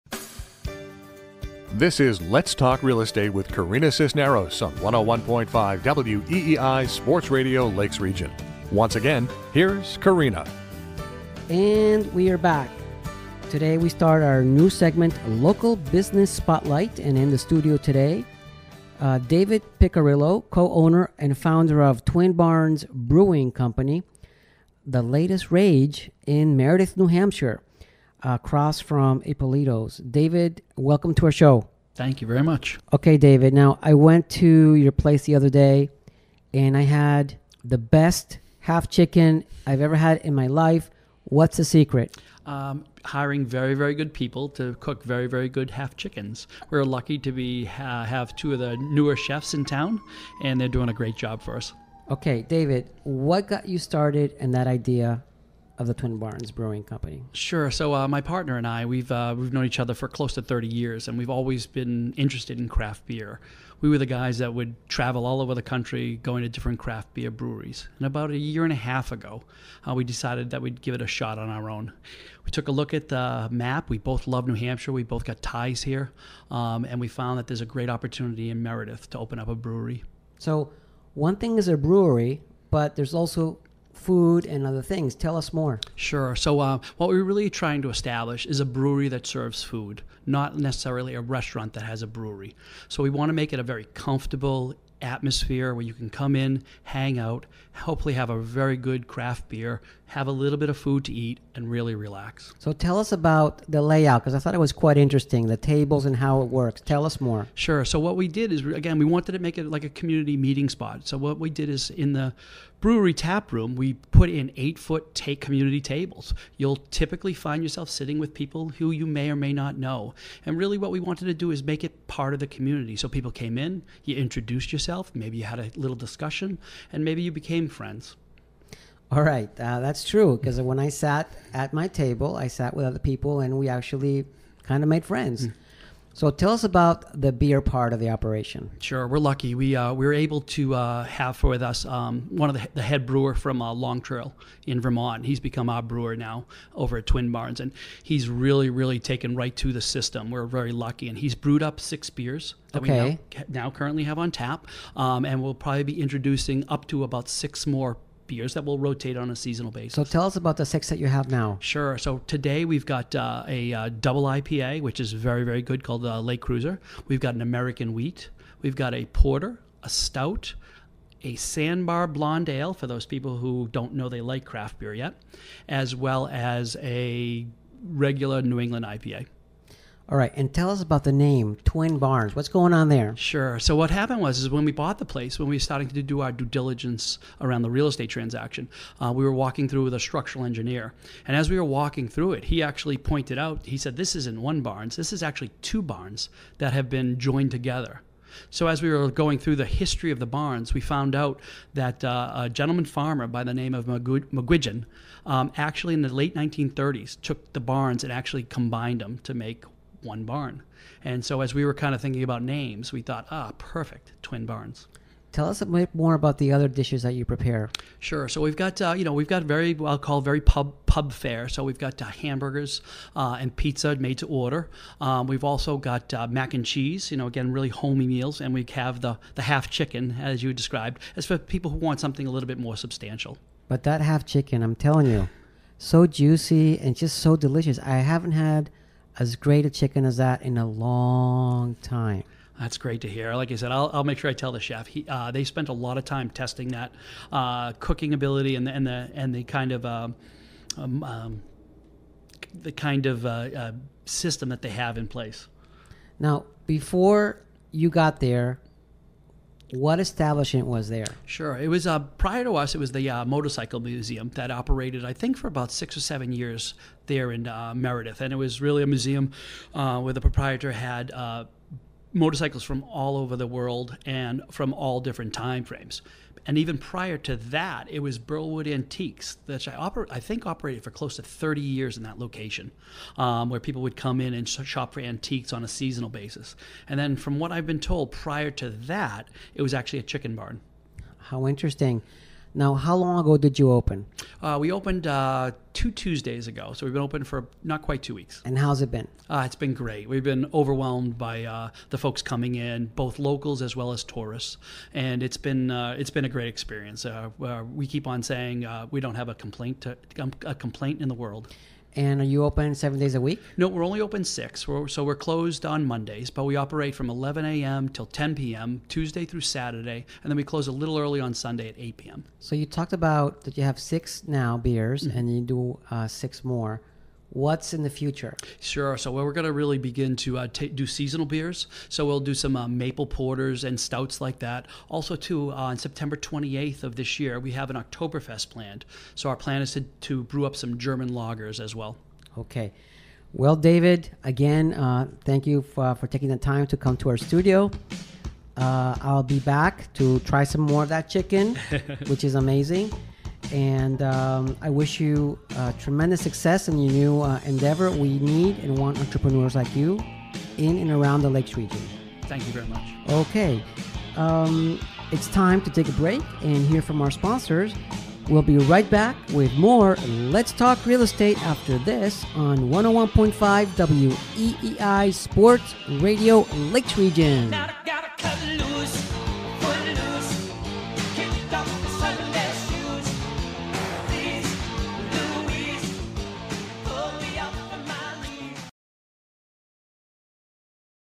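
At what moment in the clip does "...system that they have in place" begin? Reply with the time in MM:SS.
04:14.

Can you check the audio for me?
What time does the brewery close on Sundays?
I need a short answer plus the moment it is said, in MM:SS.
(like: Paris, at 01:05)
8 p.m., at 05:21.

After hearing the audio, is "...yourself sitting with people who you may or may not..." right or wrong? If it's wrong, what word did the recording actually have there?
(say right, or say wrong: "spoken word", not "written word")
right.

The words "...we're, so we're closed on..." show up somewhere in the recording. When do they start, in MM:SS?
05:14.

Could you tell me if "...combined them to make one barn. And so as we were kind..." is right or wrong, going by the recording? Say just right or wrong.
right.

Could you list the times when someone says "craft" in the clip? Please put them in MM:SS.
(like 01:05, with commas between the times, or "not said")
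01:02, 01:06, 01:39, 02:54.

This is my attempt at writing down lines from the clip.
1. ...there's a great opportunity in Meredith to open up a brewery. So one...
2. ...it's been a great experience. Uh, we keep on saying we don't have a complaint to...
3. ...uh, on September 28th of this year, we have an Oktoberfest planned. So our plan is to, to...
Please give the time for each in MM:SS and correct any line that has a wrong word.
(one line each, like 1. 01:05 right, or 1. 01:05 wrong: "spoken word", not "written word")
1. 01:17 right
2. 05:05 right
3. 05:35 right.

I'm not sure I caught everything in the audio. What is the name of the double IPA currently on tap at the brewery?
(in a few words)
Lake Cruiser.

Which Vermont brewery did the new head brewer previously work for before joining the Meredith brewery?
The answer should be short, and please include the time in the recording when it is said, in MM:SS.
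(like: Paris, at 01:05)
Long Trail, at 02:23.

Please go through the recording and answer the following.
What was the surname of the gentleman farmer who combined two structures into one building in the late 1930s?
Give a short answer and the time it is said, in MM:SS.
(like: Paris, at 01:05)
McGuigan, at 03:23.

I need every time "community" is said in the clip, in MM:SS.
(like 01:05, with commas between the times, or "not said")
01:49, 01:55, 02:02.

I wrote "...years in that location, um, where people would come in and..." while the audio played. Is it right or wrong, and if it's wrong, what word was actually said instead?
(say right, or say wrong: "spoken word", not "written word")
right.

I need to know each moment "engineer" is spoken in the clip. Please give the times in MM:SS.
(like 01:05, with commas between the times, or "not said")
03:10.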